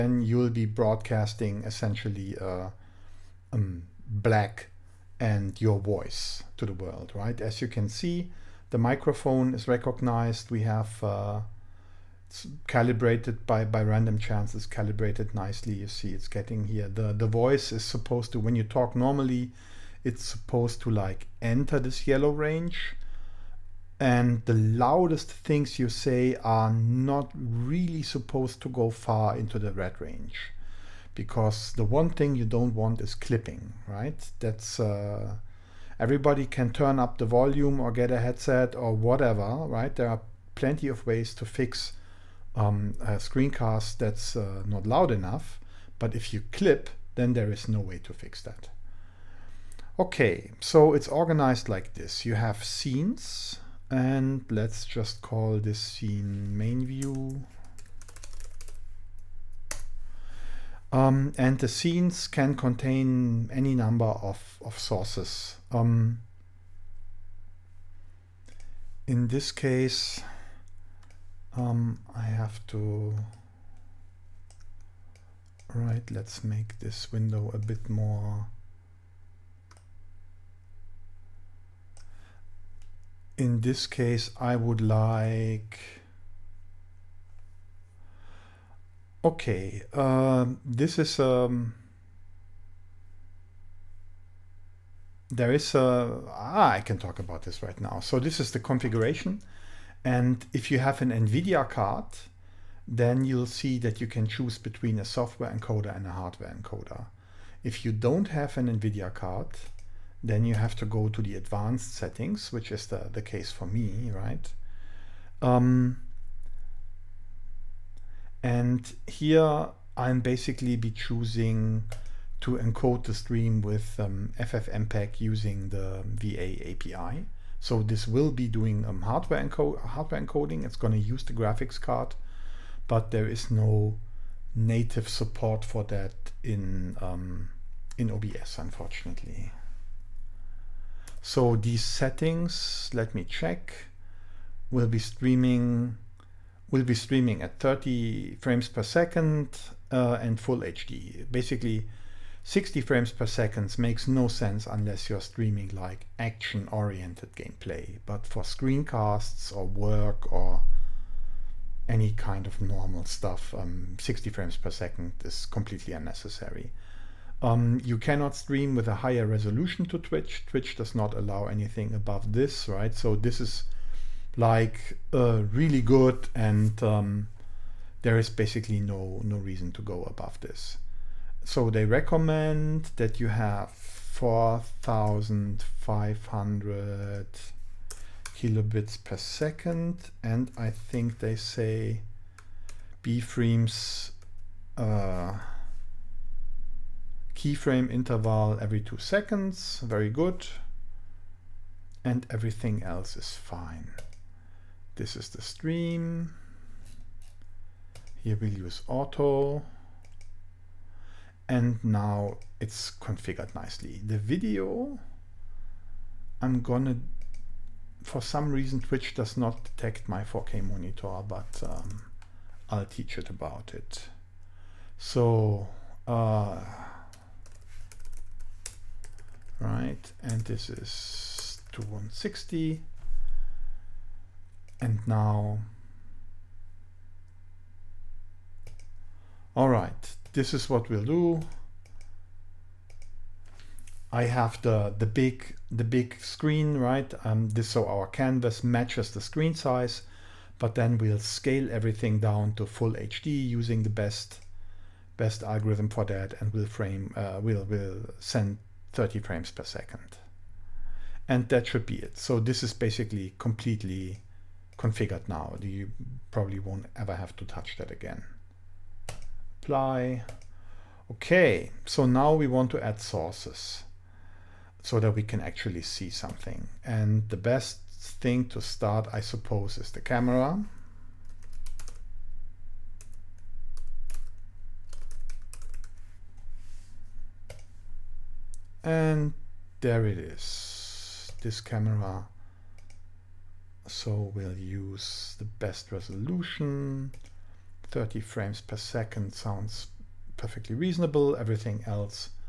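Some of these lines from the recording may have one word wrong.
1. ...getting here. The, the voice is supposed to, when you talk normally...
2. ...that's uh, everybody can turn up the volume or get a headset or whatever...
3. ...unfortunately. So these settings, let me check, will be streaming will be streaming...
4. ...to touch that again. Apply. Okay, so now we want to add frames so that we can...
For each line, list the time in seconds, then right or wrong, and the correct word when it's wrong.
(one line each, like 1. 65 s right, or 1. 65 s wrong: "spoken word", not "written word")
1. 16 s right
2. 34 s right
3. 138 s right
4. 267 s wrong: "sources", not "frames".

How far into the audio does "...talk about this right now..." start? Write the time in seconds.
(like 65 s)
96 s.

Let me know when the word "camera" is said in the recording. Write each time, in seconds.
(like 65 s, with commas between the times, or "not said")
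280 s, 291 s.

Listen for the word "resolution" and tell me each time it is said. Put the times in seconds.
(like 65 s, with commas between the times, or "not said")
169 s, 295 s.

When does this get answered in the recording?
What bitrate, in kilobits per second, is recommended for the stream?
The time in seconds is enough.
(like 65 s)
183 s.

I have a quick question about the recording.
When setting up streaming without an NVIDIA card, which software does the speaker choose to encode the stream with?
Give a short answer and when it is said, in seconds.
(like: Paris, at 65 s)
FFmpeg, at 124 s.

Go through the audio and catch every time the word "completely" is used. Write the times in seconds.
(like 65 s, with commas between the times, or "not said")
165 s, 263 s.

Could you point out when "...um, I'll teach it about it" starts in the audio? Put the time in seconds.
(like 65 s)
221 s.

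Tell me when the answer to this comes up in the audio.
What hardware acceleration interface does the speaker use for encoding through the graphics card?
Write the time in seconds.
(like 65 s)
126 s.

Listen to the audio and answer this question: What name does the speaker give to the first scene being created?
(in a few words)
main view.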